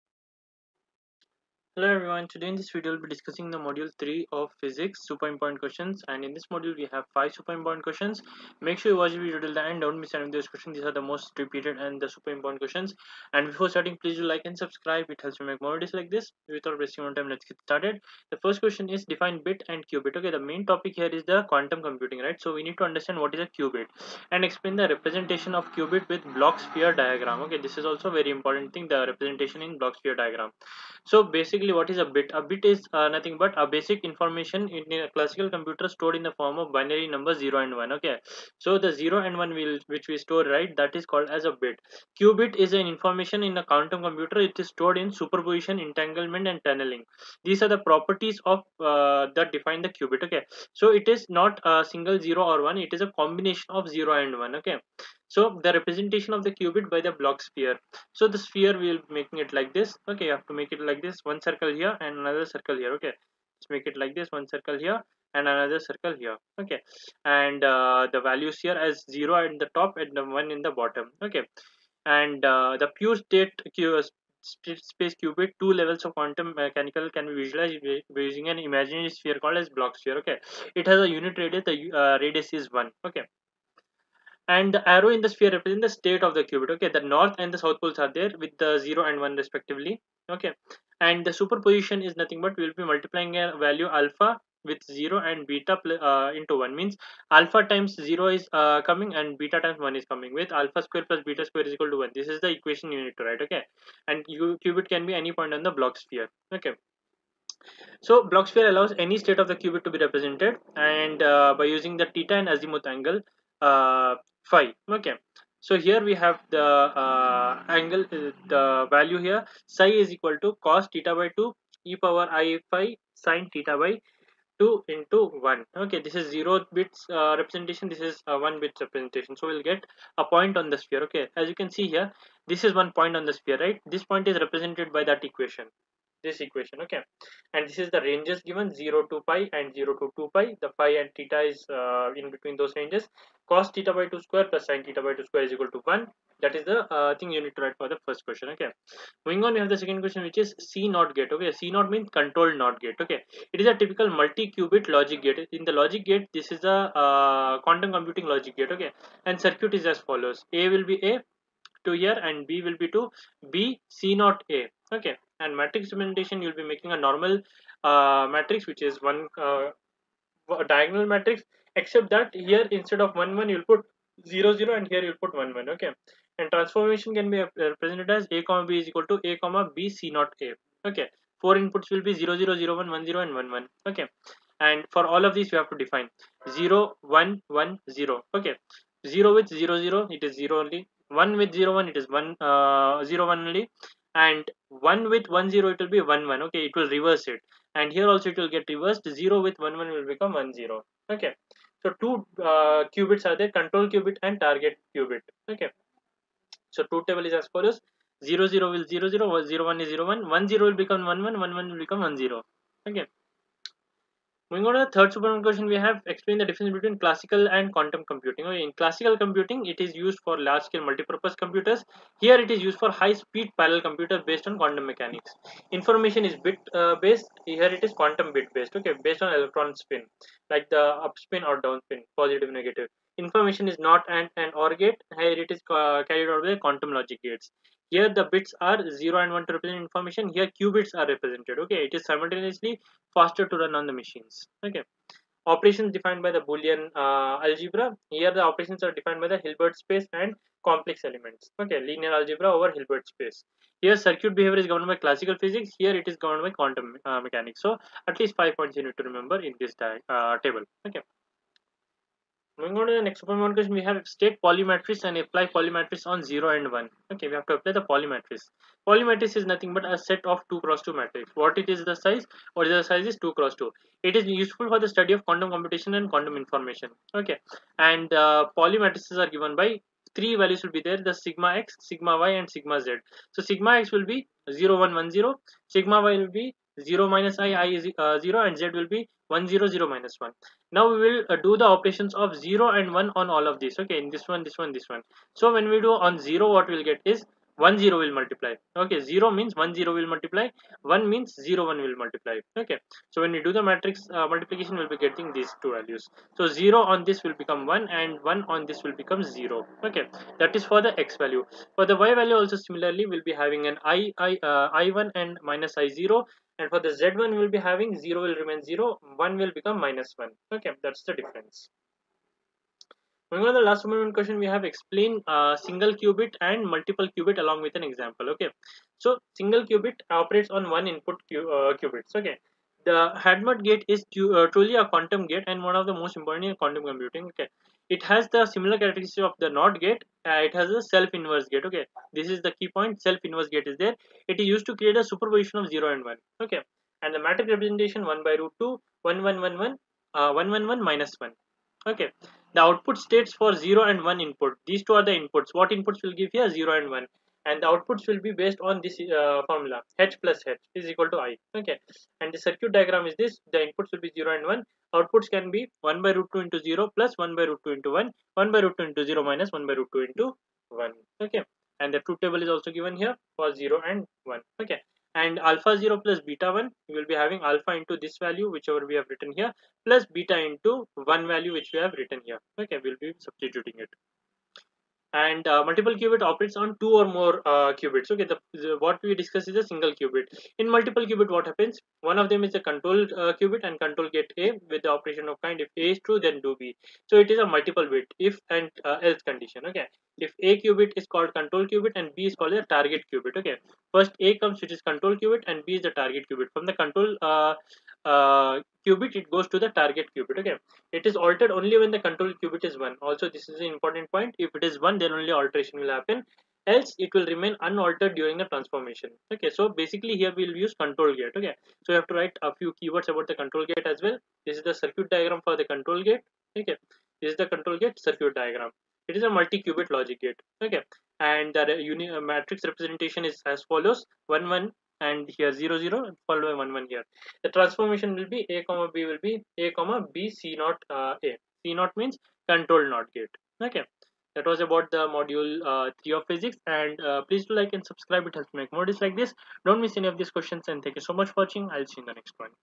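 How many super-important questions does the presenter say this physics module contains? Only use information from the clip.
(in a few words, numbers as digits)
5.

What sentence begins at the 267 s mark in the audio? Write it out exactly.
Okay, we have to apply the Pauli matrix.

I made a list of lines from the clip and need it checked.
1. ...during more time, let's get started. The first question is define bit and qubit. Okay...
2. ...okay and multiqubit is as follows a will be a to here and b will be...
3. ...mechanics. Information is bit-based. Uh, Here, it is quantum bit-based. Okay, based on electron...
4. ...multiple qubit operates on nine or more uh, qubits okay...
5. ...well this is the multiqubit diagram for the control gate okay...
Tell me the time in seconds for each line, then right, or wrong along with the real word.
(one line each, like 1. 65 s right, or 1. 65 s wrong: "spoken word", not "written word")
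1. 16 s wrong: "wasting", not "during"
2. 158 s wrong: "circuit", not "multiqubit"
3. 224 s right
4. 385 s wrong: "two", not "nine"
5. 424 s wrong: "circuit", not "multiqubit".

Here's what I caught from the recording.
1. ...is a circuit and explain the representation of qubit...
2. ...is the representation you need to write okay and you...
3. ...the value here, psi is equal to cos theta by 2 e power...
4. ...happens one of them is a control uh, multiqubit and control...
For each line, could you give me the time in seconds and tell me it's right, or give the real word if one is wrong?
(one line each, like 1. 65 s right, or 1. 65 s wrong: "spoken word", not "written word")
1. 23 s wrong: "qubit", not "circuit"
2. 102 s wrong: "equation", not "representation"
3. 118 s right
4. 391 s wrong: "qubit", not "multiqubit".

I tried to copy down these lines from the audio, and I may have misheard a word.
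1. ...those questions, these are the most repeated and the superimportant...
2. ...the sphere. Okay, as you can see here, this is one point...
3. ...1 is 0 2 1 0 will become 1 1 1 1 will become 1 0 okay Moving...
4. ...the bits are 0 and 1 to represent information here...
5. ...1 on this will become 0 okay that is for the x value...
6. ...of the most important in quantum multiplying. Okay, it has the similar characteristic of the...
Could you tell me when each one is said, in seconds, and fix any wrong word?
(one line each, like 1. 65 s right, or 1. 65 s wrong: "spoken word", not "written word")
1. 10 s right
2. 130 s right
3. 209 s wrong: "1", not "2"
4. 238 s right
5. 308 s right
6. 335 s wrong: "computing", not "multiplying".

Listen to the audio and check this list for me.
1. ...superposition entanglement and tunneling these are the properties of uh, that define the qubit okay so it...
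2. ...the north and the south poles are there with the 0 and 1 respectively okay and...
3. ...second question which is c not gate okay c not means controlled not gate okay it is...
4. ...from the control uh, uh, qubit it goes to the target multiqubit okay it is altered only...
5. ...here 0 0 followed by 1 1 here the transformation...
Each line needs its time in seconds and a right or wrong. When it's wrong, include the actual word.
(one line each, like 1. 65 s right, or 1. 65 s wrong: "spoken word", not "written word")
1. 45 s right
2. 86 s right
3. 149 s right
4. 406 s wrong: "qubit", not "multiqubit"
5. 435 s right.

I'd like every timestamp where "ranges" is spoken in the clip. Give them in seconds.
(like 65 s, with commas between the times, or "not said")
138 s, 142 s.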